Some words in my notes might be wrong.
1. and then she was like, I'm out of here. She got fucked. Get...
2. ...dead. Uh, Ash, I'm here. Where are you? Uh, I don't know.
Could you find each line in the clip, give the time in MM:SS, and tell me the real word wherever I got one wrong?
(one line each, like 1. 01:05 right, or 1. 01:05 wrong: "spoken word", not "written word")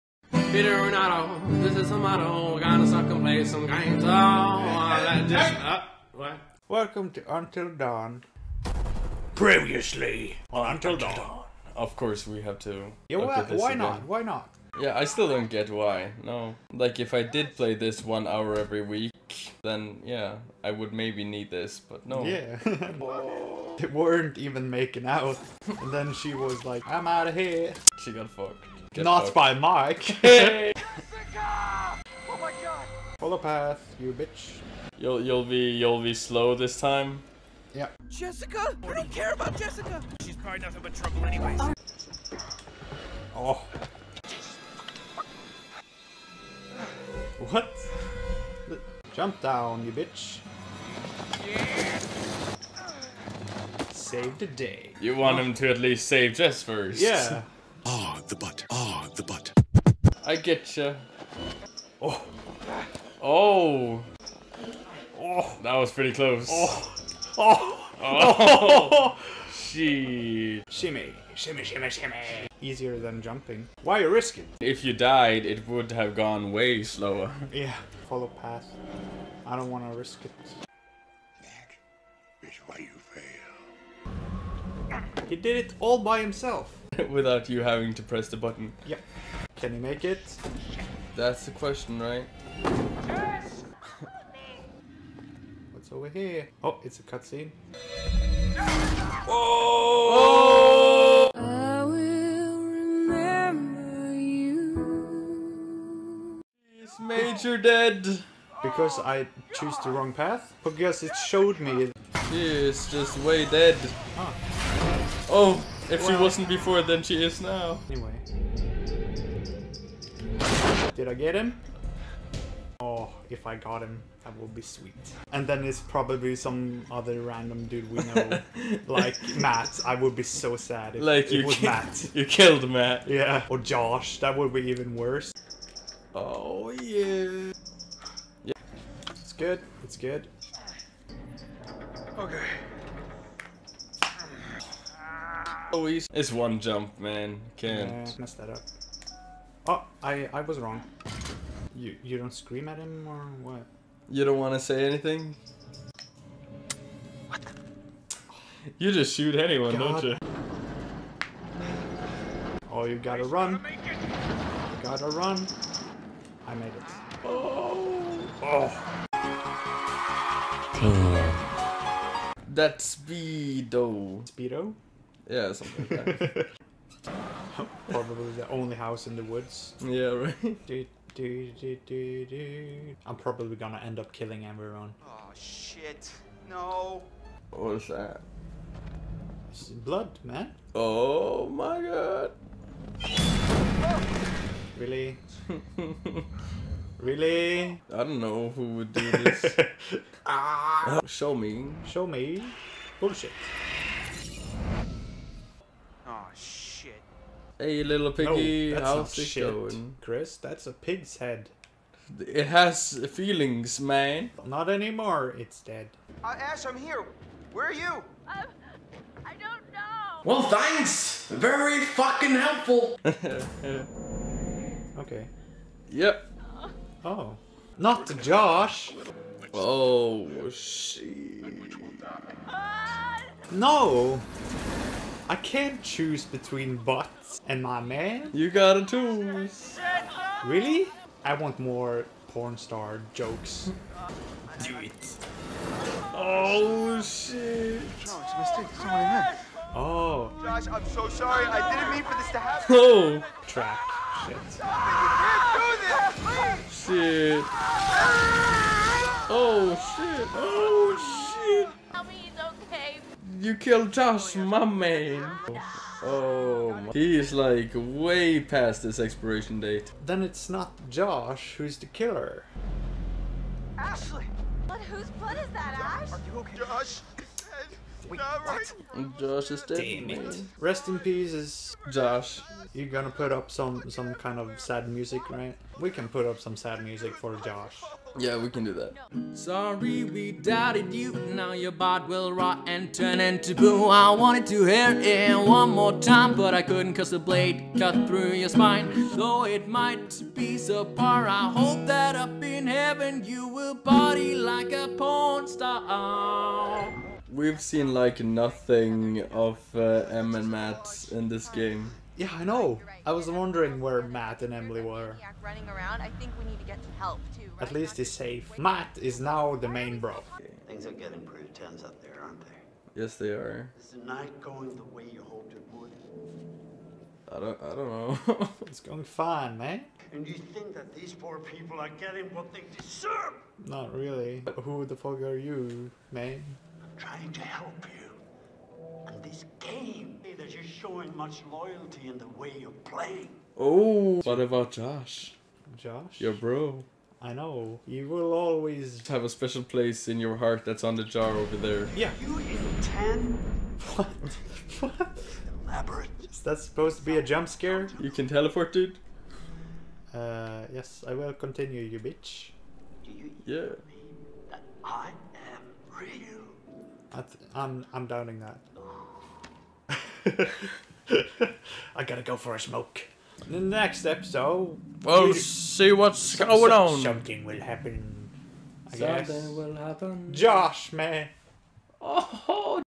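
1. 00:25 right
2. 03:35 right.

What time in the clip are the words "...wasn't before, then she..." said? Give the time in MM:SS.
01:56.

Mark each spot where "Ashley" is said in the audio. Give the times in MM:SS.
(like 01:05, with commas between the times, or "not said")
04:33.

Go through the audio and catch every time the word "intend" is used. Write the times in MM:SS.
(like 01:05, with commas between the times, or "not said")
05:52.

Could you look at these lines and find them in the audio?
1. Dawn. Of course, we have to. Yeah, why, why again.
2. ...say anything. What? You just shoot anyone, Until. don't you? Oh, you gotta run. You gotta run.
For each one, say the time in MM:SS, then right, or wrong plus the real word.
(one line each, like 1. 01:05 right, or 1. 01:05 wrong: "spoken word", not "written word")
1. 00:11 right
2. 02:34 wrong: "God", not "Until".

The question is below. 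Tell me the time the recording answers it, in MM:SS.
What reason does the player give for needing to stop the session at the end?
06:12.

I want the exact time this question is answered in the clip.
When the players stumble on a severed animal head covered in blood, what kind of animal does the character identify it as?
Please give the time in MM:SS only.
03:30.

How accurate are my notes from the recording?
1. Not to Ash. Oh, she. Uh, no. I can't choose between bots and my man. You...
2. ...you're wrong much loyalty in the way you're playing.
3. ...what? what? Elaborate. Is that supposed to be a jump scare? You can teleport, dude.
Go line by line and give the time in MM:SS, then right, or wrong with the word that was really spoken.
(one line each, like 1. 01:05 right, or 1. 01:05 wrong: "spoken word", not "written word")
1. 03:47 wrong: "Josh", not "Ash"
2. 05:40 wrong: "showing", not "wrong"
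3. 05:53 right.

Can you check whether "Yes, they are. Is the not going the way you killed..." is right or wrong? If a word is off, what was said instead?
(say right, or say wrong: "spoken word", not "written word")
wrong: "hoped", not "killed".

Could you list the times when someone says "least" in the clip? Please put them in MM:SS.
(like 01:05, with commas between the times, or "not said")
00:55, 05:17.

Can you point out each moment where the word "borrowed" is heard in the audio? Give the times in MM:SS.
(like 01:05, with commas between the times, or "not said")
not said.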